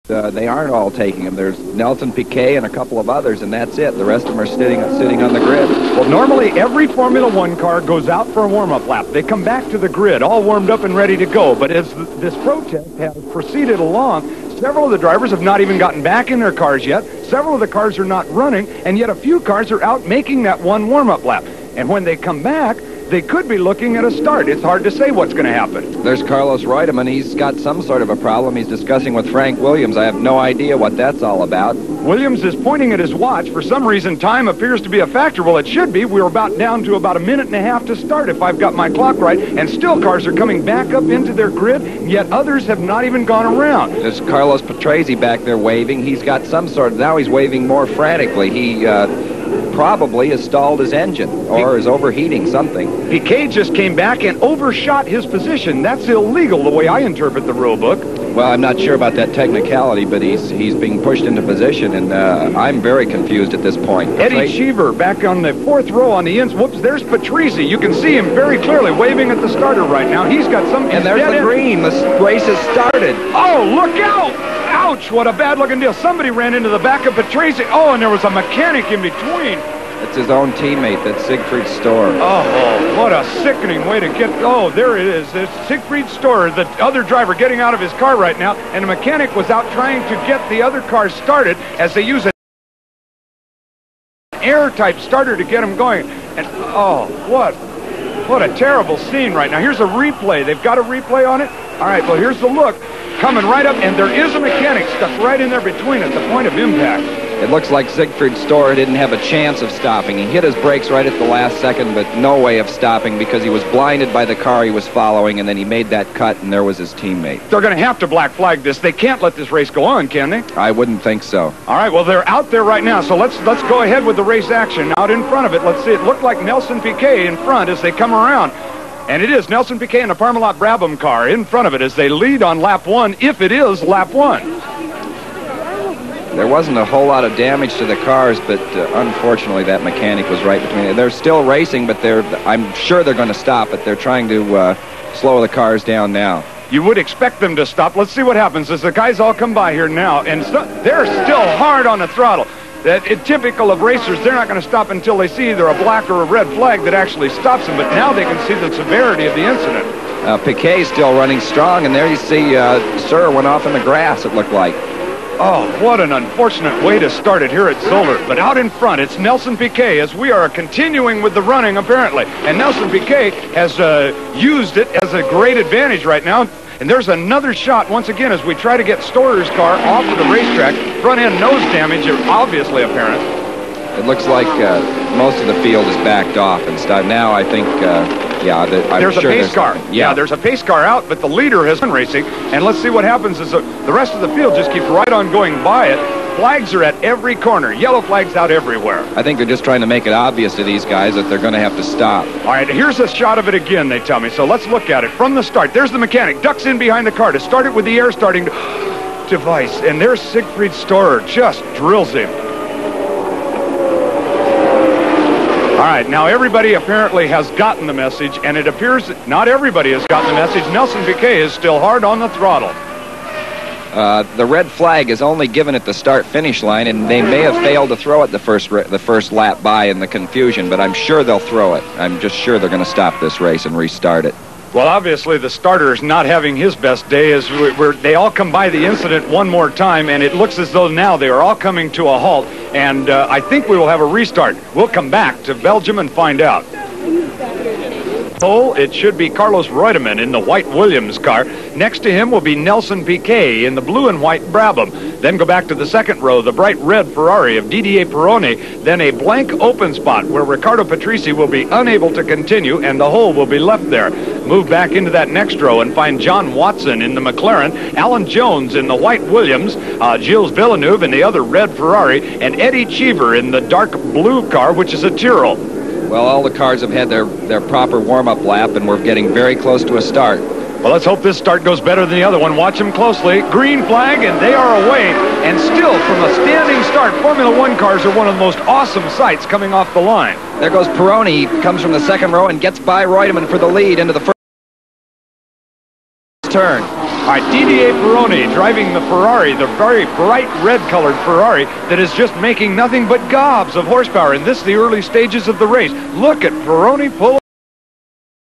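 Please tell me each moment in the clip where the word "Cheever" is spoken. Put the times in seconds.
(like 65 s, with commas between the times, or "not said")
64 s, 272 s.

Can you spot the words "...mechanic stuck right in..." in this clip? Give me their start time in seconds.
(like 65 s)
104 s.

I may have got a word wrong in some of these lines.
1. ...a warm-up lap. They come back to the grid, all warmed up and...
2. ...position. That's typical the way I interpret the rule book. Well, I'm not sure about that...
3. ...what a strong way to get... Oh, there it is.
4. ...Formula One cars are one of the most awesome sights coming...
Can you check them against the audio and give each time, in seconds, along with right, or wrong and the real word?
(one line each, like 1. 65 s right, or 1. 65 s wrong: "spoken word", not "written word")
1. 8 s right
2. 55 s wrong: "illegal", not "typical"
3. 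82 s wrong: "sickening", not "strong"
4. 287 s right.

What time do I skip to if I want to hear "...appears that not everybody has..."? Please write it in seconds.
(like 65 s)
218 s.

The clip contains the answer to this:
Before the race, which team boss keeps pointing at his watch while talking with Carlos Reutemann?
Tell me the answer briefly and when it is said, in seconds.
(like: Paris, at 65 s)
Frank Williams, at 29 s.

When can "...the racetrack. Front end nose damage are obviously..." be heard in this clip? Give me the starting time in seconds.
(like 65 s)
180 s.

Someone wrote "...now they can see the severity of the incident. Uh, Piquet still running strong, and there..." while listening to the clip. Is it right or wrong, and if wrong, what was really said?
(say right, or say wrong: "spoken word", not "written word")
right.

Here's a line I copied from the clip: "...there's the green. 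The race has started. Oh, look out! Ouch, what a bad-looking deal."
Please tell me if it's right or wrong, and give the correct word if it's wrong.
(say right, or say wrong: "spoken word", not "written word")
right.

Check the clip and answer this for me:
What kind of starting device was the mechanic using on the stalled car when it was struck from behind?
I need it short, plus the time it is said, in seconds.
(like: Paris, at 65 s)
air-type starter, at 94 s.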